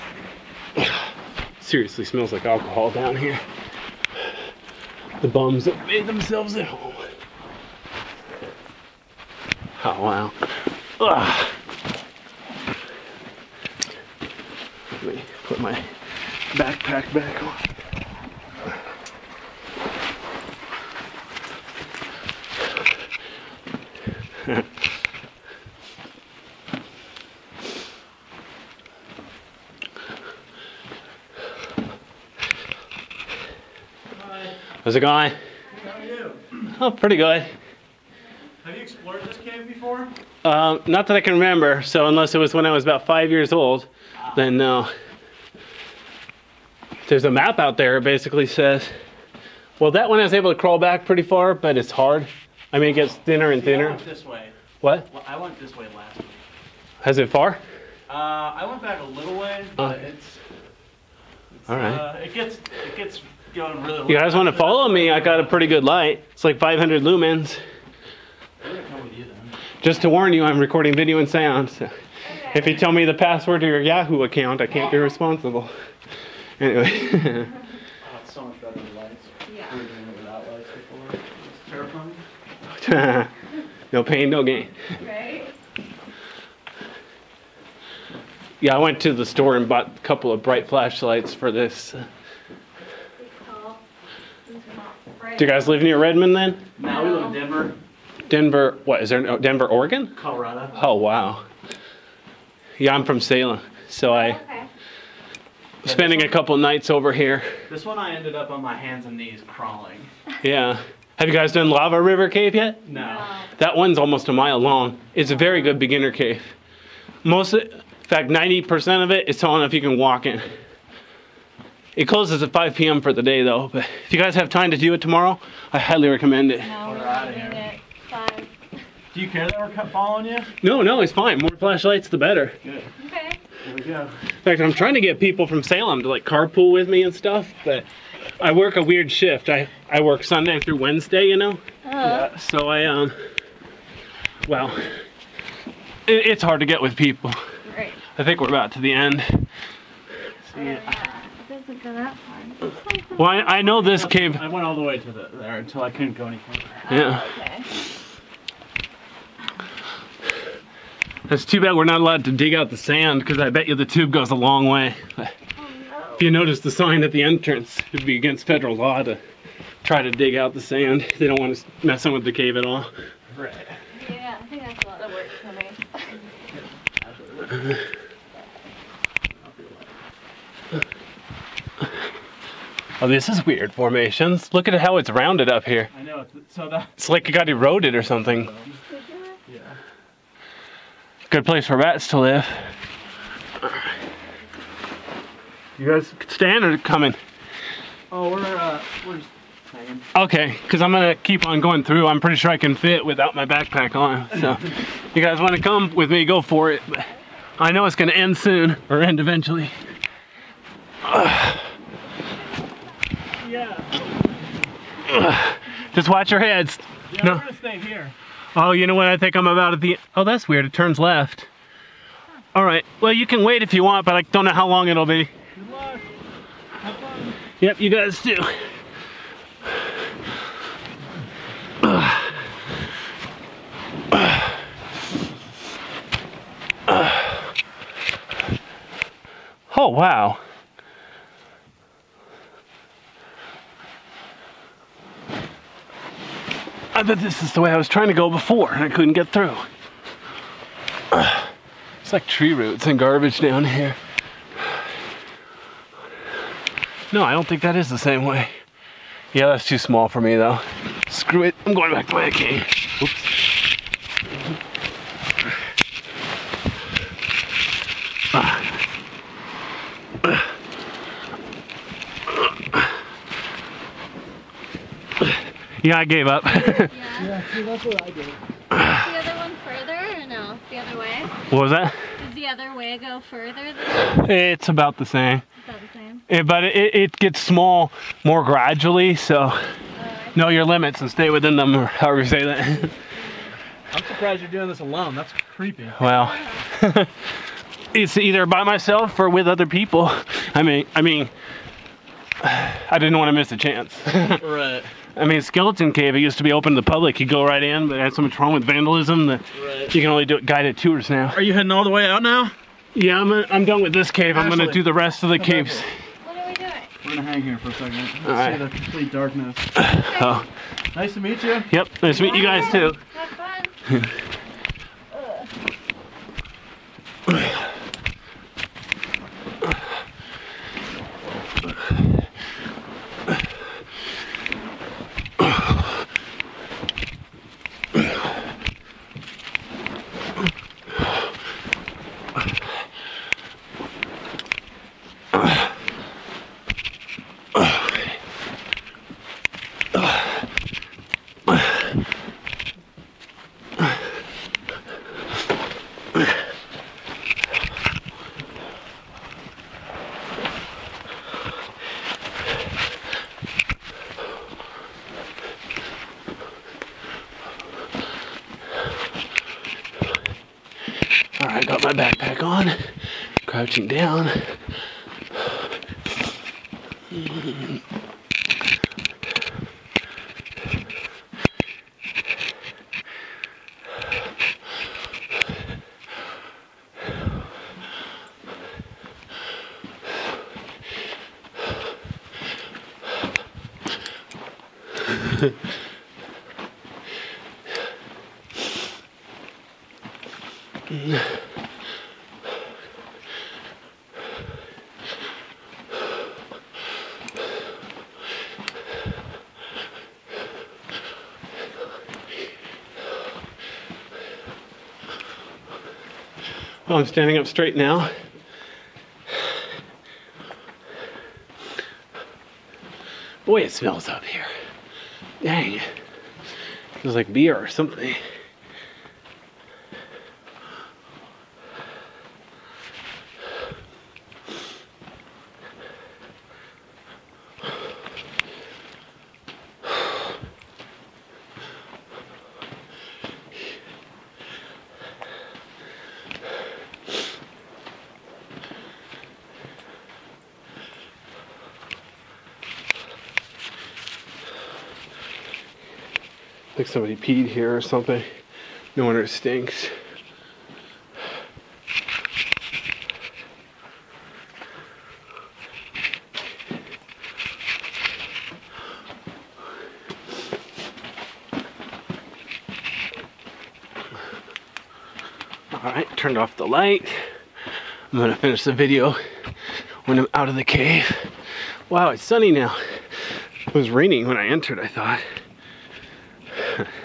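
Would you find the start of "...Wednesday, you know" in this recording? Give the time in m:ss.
2:20.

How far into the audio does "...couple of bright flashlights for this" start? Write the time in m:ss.
1:30.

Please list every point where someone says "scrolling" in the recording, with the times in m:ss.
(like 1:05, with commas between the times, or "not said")
not said.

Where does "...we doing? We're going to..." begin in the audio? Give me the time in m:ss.
5:16.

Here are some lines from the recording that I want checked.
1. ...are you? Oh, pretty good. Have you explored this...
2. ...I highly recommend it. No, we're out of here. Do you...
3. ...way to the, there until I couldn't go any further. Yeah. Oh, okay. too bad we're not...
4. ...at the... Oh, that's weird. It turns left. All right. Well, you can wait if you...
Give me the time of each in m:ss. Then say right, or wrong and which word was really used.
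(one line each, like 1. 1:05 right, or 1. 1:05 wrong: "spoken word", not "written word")
1. 0:35 right
2. 2:05 right
3. 2:34 right
4. 3:39 right.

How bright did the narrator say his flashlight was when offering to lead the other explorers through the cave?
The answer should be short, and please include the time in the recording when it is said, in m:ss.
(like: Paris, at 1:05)
500 lumens, at 1:06.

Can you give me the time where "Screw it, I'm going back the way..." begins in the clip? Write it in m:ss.
4:21.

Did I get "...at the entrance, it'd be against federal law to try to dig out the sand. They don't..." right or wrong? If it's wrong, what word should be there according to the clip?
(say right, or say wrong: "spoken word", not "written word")
right.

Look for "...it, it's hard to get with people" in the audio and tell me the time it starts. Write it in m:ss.
2:26.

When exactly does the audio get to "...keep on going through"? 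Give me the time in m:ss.
3:21.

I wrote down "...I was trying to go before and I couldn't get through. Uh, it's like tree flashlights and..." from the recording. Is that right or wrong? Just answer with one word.
wrong.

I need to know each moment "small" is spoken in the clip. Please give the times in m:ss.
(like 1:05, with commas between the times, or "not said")
4:19, 4:47.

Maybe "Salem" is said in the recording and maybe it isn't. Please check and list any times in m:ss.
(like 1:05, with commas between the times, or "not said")
1:43, 2:15.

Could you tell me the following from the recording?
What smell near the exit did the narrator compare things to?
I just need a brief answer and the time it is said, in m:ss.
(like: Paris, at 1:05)
Beer, at 7:07.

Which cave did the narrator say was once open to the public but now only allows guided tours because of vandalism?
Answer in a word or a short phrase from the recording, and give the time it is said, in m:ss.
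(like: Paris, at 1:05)
Skeleton Cave, at 5:05.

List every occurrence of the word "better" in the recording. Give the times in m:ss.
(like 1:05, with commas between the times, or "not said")
1:18, 2:12.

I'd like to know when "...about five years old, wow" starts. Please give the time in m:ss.
0:42.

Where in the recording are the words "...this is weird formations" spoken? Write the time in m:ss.
3:03.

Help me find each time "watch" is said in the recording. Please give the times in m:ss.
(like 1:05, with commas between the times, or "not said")
3:36.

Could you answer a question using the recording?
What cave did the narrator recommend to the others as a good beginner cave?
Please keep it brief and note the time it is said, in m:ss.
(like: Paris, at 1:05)
Lava River Cave, at 1:51.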